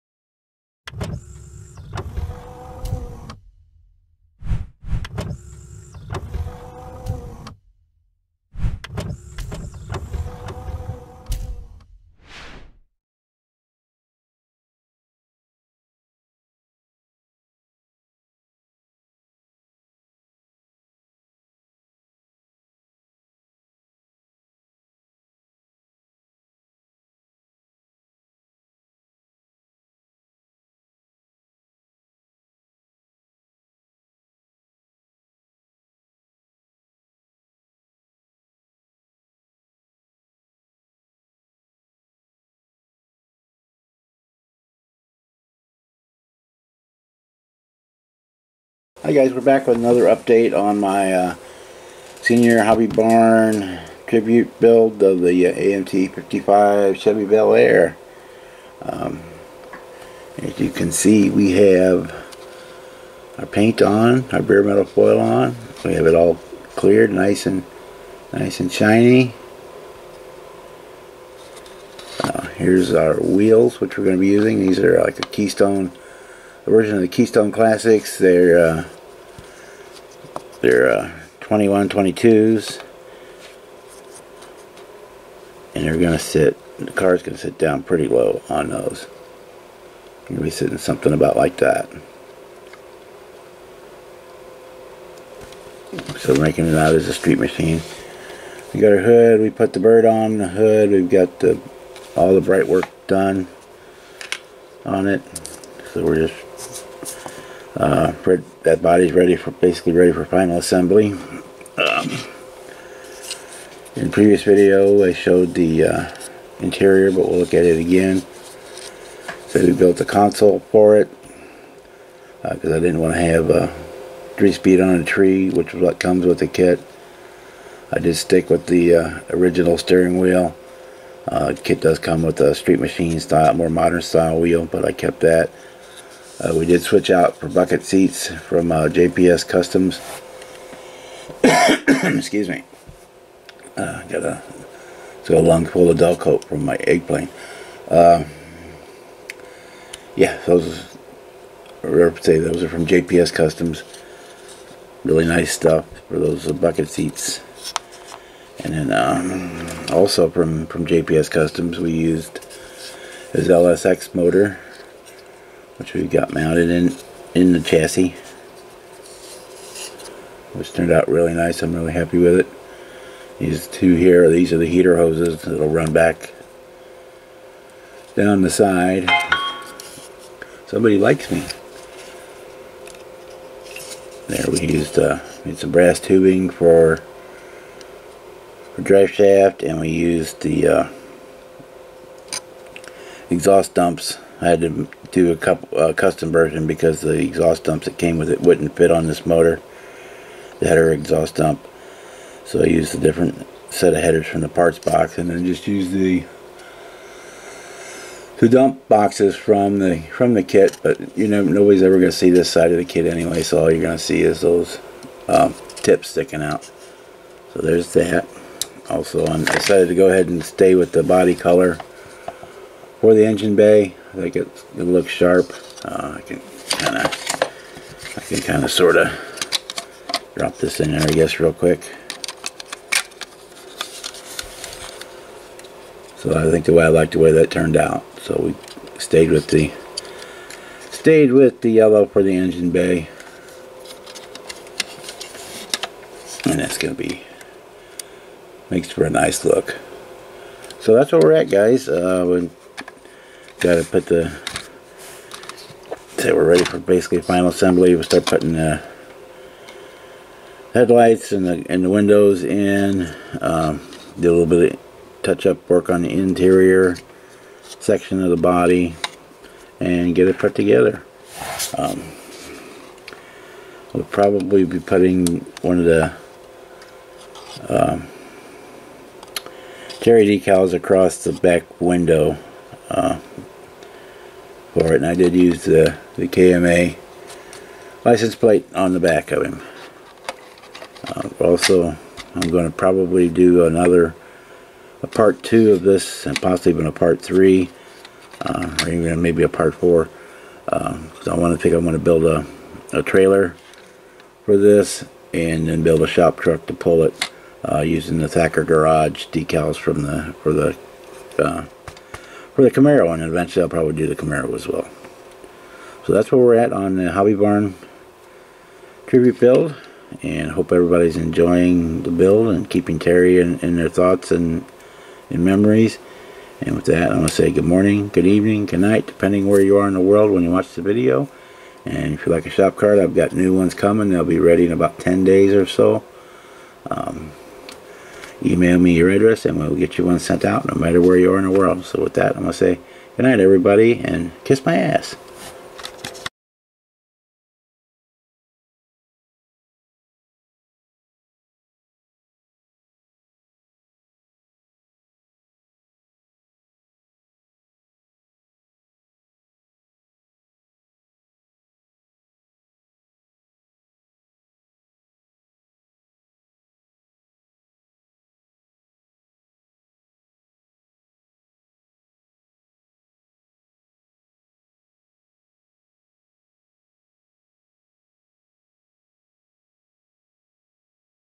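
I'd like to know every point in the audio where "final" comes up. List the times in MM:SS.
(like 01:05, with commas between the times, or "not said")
01:50, 04:17.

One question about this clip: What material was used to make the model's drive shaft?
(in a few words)
brass tubing.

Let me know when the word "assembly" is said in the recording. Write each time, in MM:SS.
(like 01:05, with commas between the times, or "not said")
01:50, 04:17.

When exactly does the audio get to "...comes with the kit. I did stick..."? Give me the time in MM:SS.
02:05.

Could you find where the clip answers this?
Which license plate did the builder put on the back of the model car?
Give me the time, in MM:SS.
04:46.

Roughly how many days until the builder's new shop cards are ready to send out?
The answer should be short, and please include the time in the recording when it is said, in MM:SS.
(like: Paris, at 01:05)
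10 days, at 05:34.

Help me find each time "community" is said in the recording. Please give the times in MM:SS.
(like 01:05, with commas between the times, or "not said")
not said.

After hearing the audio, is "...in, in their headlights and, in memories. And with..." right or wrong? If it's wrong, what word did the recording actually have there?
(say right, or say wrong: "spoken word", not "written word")
wrong: "thoughts", not "headlights".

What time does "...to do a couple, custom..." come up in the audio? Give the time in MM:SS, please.
03:14.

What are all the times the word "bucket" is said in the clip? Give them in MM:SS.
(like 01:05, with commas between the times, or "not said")
02:17, 02:36.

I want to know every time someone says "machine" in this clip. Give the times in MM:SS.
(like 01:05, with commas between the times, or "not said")
01:37, 02:12.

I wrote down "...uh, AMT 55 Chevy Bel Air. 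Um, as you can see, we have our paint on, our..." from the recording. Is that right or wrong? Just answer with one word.
right.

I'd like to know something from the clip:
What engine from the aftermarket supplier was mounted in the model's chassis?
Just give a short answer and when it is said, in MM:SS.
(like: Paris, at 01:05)
LSX motor, at 02:43.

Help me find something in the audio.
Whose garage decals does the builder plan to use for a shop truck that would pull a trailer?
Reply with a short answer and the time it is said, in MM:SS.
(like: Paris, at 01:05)
Thacker garage, at 05:08.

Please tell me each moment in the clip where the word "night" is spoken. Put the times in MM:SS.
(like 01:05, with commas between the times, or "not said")
05:28, 05:43.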